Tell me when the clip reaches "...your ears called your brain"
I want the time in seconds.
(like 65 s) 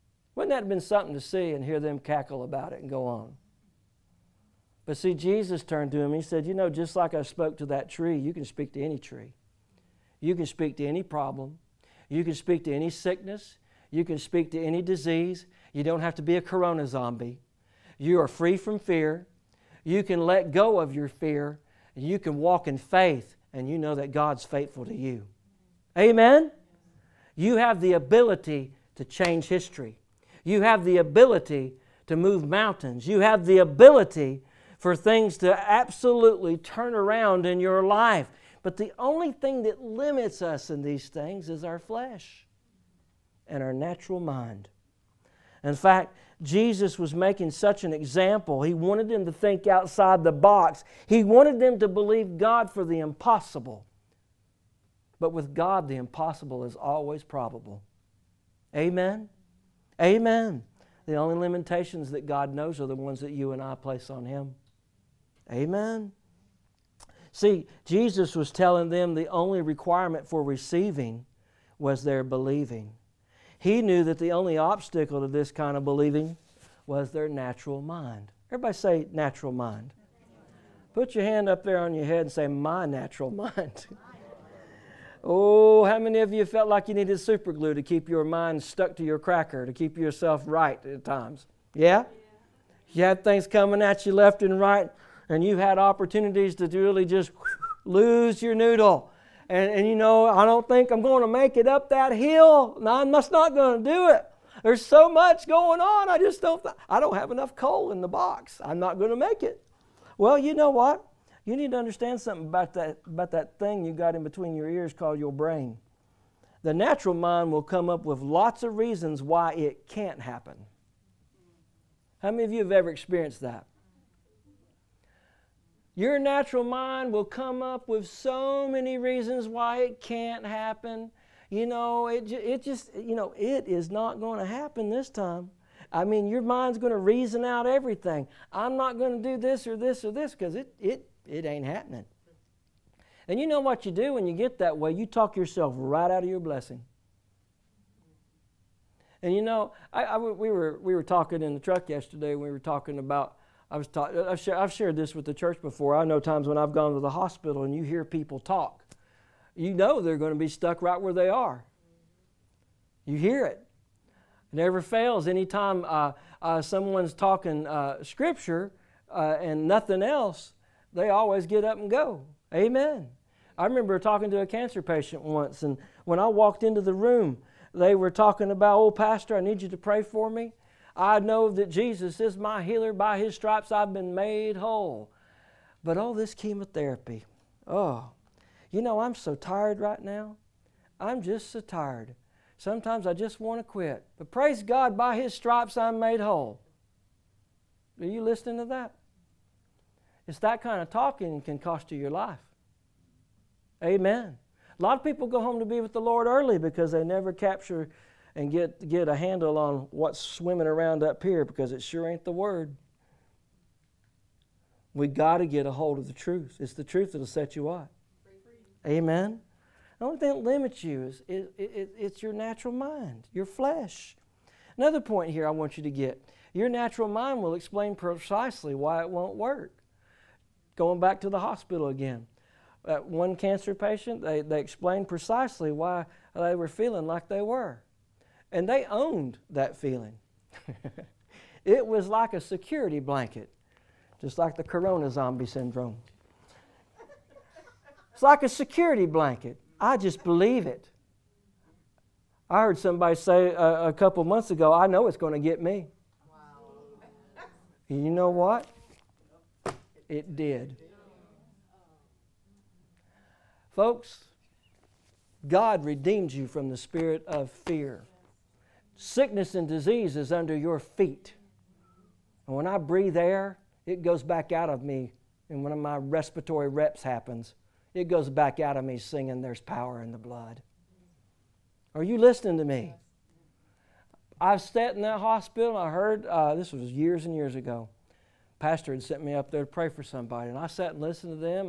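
114 s.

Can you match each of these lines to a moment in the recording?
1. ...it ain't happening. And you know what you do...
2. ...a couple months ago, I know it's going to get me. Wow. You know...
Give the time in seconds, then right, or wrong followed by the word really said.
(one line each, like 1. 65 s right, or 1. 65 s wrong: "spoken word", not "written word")
1. 141 s right
2. 253 s right.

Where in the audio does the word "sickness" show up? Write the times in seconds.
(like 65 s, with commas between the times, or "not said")
12 s, 268 s.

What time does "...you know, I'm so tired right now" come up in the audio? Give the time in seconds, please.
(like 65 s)
188 s.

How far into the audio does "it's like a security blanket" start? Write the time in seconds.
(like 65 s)
248 s.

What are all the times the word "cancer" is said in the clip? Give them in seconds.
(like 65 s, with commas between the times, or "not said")
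174 s, 233 s.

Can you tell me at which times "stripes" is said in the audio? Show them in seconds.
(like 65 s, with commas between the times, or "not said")
183 s, 195 s.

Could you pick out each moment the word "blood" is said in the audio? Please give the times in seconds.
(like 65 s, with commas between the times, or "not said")
280 s.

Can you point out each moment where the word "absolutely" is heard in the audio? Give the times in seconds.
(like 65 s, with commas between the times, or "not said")
35 s.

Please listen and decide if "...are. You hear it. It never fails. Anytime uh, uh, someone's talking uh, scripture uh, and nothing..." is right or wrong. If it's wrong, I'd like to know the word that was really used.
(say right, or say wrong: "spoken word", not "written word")
right.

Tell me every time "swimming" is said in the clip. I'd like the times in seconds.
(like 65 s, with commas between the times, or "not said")
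210 s.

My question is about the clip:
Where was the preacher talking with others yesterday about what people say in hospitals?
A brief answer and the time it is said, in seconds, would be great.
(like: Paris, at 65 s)
in the truck, at 151 s.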